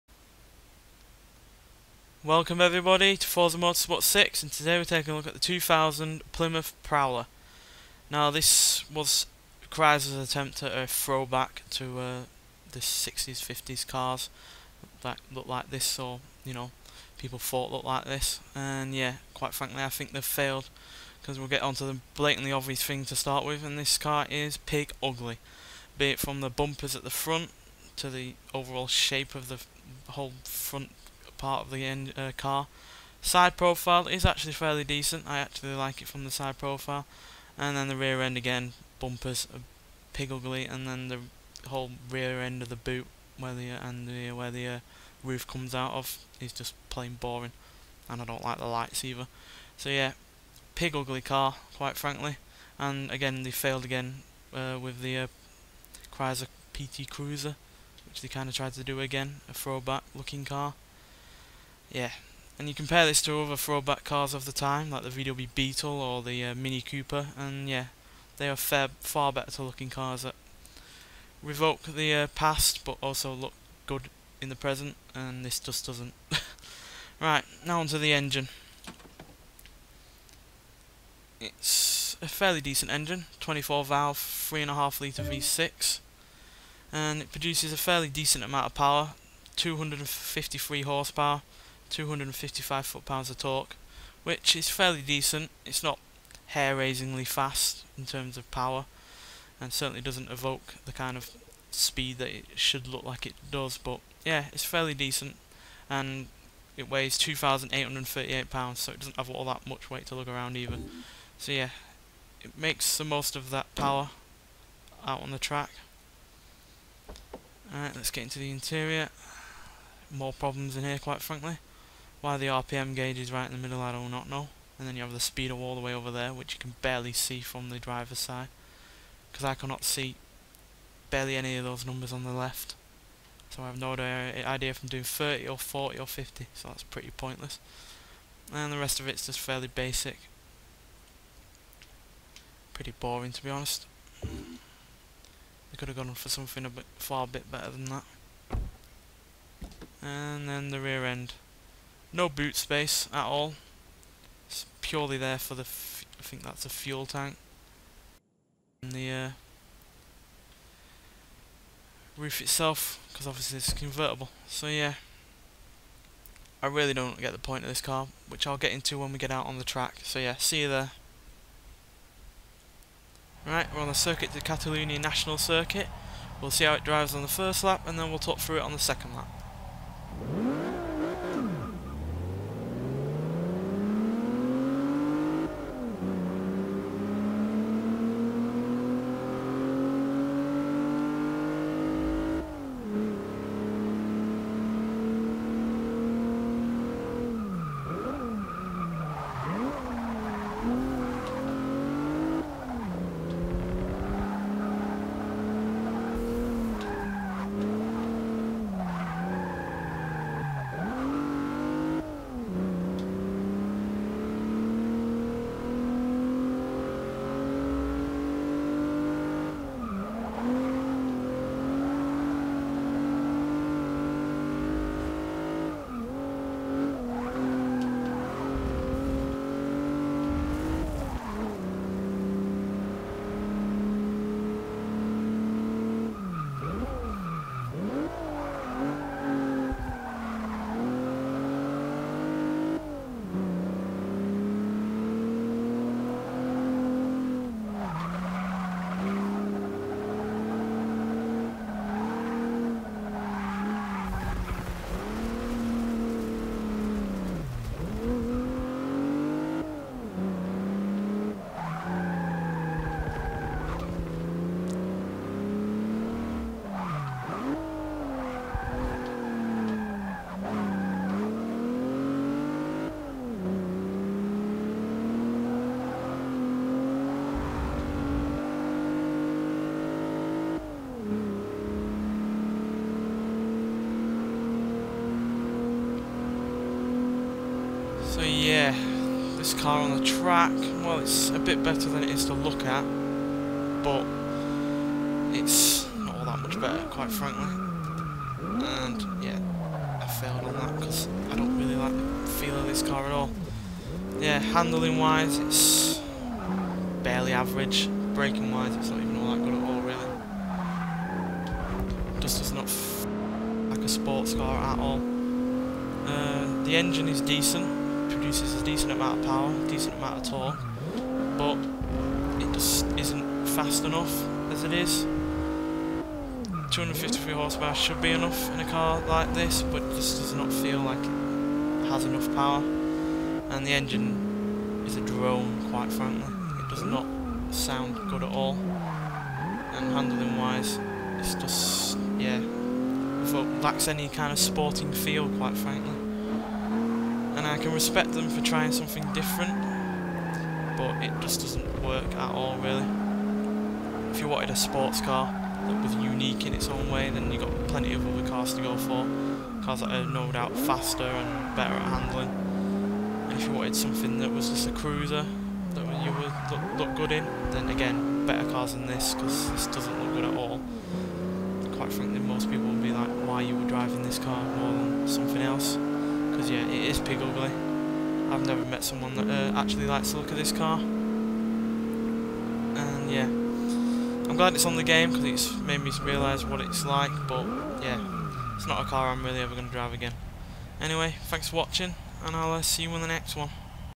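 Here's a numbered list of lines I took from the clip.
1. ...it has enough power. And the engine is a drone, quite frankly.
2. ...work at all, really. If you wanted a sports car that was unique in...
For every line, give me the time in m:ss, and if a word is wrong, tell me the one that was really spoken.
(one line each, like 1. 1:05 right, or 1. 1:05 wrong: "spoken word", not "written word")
1. 5:30 right
2. 5:51 right.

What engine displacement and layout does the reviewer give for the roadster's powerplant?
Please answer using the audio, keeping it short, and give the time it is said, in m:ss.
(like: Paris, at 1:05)
3.5 litre V6, at 1:24.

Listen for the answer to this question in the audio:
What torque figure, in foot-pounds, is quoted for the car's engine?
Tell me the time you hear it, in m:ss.
1:31.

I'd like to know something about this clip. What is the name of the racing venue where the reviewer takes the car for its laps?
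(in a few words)
Circuit de Catalunya.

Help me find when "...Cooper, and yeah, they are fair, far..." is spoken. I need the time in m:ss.
1:06.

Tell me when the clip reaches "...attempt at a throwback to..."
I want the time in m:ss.
0:10.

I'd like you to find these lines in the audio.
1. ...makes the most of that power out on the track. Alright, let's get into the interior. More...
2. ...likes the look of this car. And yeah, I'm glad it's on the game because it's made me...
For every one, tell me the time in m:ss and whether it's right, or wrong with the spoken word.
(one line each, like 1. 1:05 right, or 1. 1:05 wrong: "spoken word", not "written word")
1. 1:52 right
2. 6:19 right.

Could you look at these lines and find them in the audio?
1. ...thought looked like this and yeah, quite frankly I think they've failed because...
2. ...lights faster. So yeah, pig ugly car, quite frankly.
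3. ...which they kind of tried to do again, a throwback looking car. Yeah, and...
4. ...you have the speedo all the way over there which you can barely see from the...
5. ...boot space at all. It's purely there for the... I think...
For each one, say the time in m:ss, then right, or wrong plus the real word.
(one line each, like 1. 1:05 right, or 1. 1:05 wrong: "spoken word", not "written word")
1. 0:17 right
2. 0:48 wrong: "either", not "faster"
3. 0:58 right
4. 2:04 right
5. 2:32 right.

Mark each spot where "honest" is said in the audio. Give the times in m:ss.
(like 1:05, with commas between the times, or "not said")
2:23.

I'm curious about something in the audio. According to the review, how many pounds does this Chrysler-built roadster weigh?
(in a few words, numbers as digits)
2,838.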